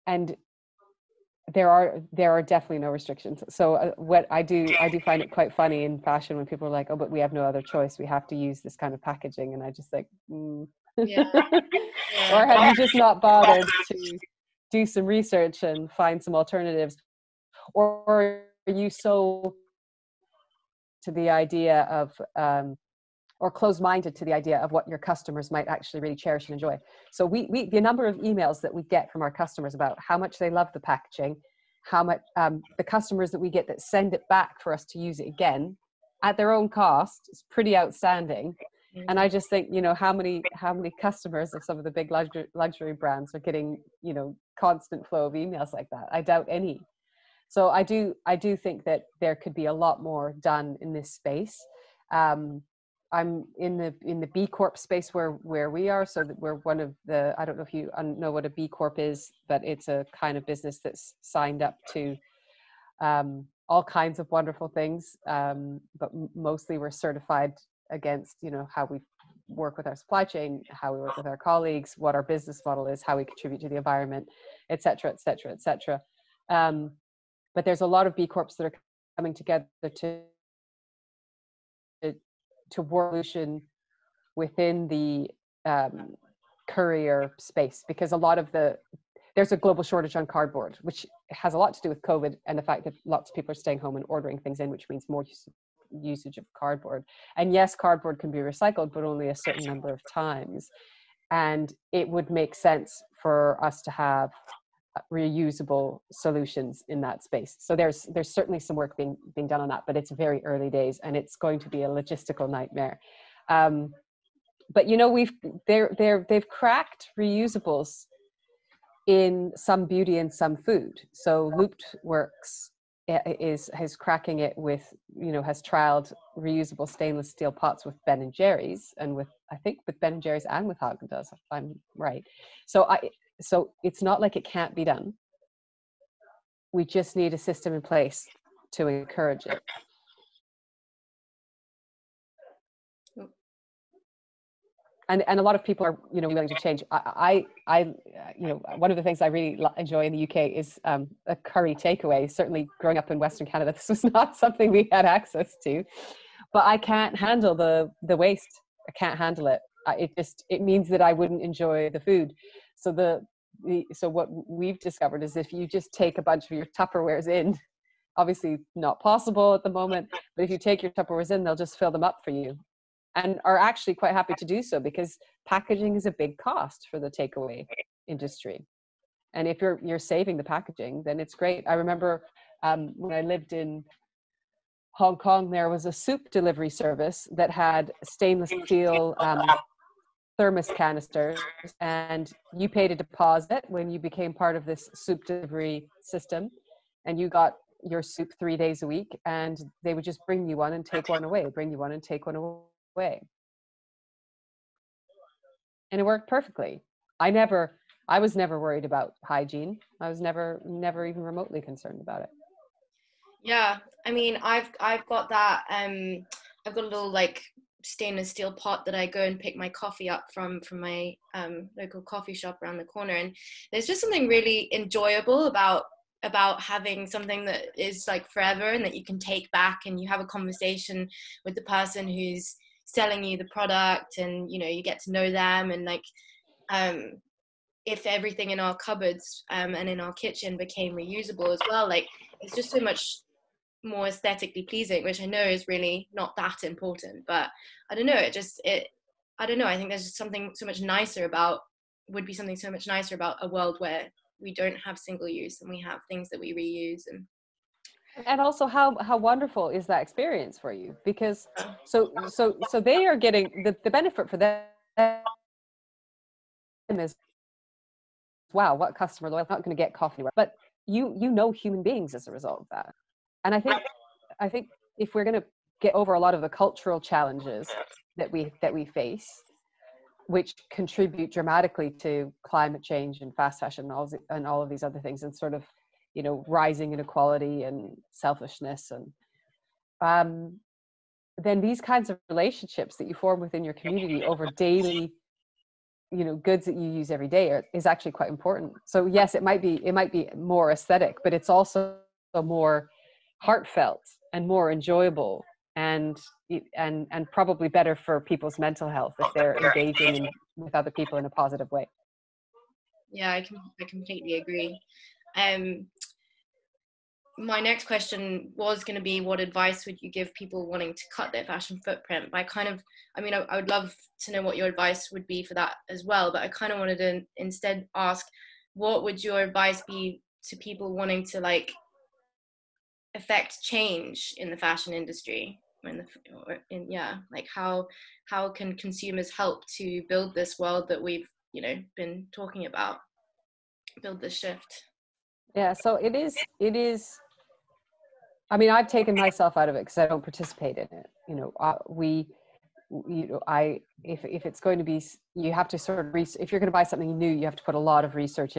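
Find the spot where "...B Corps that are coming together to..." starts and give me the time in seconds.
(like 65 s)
78 s.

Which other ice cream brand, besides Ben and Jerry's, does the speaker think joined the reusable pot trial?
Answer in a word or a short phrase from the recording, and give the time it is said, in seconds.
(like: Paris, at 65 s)
Haagen Dazs, at 130 s.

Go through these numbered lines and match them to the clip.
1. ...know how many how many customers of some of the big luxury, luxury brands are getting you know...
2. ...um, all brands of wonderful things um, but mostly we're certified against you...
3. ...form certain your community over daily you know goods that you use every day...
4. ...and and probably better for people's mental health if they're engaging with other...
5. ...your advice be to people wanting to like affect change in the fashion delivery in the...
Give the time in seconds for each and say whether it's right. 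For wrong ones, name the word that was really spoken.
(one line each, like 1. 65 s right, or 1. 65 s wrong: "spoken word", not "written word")
1. 39 s right
2. 62 s wrong: "kinds", not "brands"
3. 293 s wrong: "within", not "certain"
4. 306 s right
5. 329 s wrong: "industry", not "delivery".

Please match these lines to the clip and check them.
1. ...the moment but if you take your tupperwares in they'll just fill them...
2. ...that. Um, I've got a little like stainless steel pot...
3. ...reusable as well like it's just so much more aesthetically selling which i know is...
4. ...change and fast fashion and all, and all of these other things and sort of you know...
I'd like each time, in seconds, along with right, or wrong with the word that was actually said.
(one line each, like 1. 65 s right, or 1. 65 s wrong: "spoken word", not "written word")
1. 169 s right
2. 215 s right
3. 240 s wrong: "pleasing", not "selling"
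4. 282 s right.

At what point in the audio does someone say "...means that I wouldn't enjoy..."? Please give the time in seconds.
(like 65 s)
160 s.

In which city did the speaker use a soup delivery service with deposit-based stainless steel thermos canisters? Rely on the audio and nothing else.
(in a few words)
Hong Kong.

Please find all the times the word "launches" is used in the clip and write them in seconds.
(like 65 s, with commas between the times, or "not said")
not said.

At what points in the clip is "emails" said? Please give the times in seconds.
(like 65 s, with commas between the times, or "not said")
28 s, 45 s.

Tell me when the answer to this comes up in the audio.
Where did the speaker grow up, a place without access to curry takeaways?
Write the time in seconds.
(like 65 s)
153 s.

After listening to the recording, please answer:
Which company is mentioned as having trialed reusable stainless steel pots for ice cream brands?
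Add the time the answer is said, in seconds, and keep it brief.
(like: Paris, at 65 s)
Looped Works, at 121 s.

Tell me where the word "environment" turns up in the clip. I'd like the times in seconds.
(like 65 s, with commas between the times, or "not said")
73 s.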